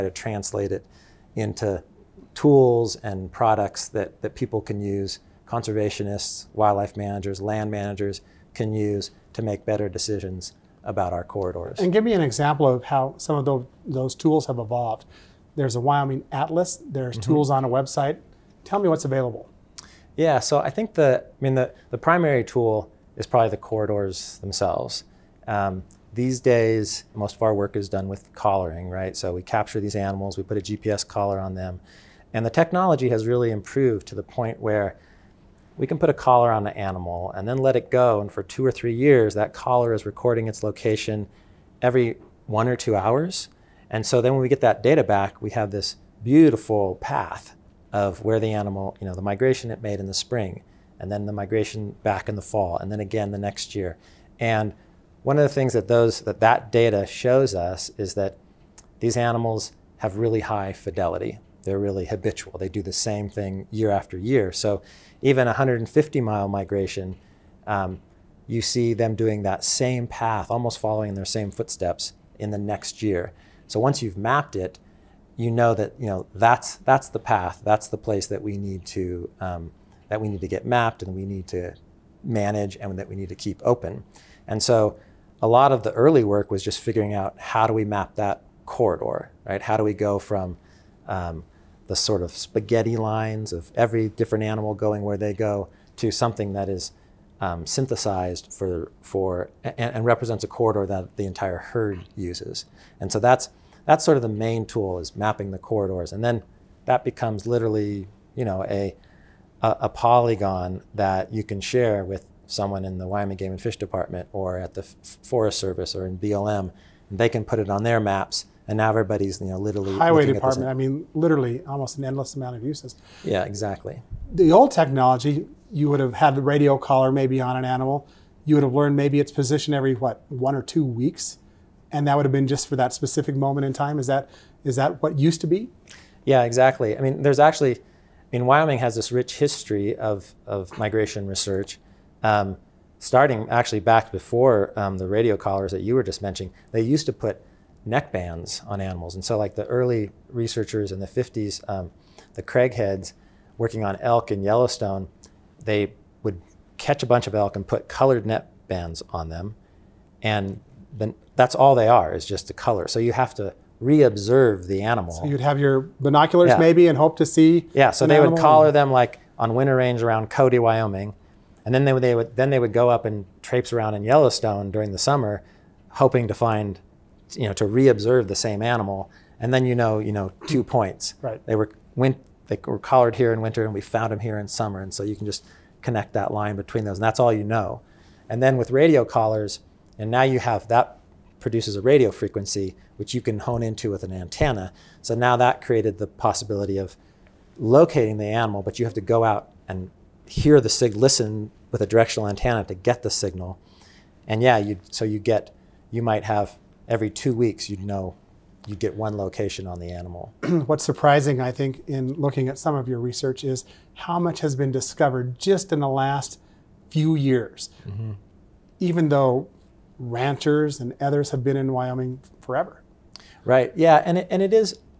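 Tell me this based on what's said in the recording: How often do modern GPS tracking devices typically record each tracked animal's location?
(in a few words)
every 1 or 2 hours.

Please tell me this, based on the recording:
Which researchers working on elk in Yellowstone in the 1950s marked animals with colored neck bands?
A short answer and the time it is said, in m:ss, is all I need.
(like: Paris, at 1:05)
the Craigheads, at 2:32.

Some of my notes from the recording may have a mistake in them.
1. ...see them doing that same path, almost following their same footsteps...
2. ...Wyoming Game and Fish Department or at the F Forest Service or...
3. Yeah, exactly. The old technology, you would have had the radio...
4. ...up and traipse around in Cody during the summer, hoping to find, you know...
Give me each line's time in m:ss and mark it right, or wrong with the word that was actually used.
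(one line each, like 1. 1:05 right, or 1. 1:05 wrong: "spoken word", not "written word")
1. 1:08 right
2. 1:53 right
3. 2:03 right
4. 2:52 wrong: "Yellowstone", not "Cody".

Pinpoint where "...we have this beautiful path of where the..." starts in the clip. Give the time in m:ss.
0:45.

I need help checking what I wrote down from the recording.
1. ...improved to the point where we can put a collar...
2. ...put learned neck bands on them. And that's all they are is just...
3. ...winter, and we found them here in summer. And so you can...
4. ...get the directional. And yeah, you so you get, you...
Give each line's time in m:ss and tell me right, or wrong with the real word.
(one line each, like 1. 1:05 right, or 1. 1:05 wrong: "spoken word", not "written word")
1. 0:33 right
2. 2:37 wrong: "colored", not "learned"
3. 3:03 right
4. 3:22 wrong: "signal", not "directional".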